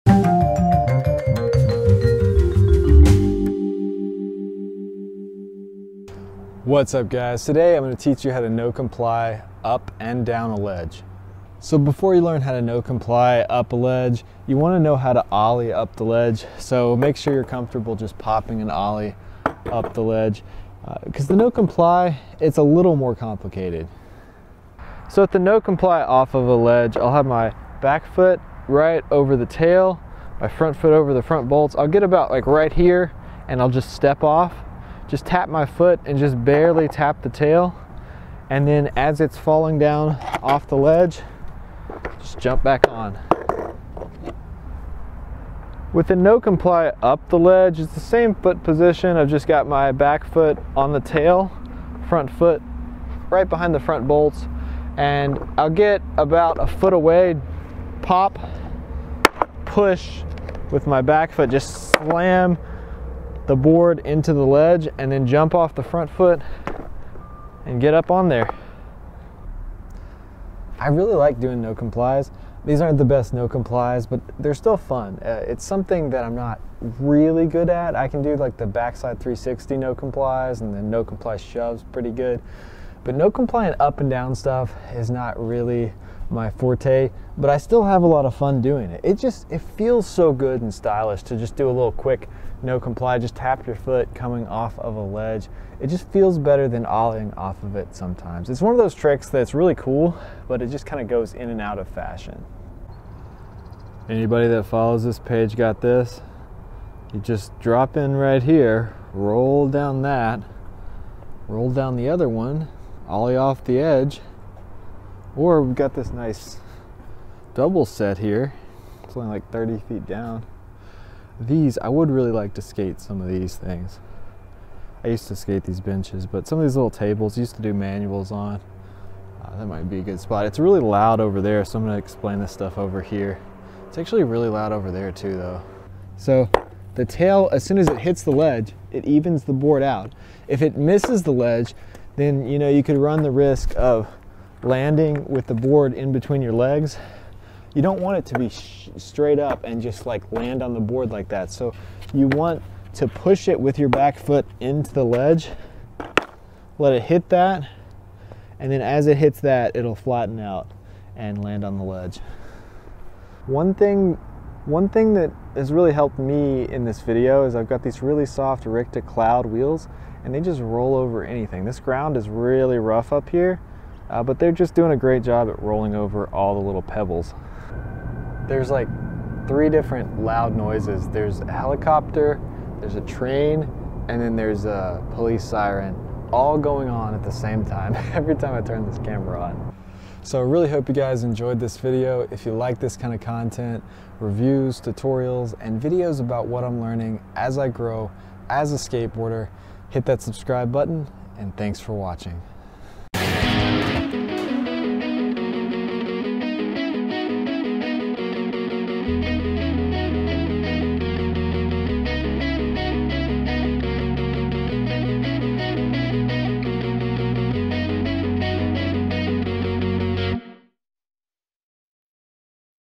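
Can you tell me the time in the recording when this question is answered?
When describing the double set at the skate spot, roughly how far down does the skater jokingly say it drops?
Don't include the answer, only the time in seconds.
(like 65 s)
119 s.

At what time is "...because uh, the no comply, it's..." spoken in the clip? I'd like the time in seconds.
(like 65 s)
21 s.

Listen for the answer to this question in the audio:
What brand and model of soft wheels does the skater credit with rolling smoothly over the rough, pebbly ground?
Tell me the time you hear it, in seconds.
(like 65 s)
168 s.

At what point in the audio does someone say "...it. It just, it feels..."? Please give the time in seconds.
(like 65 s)
88 s.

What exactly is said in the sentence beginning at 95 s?
It just feels better than ollieing off of it sometimes.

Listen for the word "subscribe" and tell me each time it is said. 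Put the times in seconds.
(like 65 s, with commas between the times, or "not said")
200 s.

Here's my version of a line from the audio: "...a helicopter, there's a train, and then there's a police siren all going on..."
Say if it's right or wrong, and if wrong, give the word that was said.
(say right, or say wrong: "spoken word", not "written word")
right.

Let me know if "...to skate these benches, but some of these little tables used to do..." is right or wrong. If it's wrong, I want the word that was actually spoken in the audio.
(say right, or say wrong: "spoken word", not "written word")
right.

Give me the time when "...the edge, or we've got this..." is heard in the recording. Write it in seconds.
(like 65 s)
113 s.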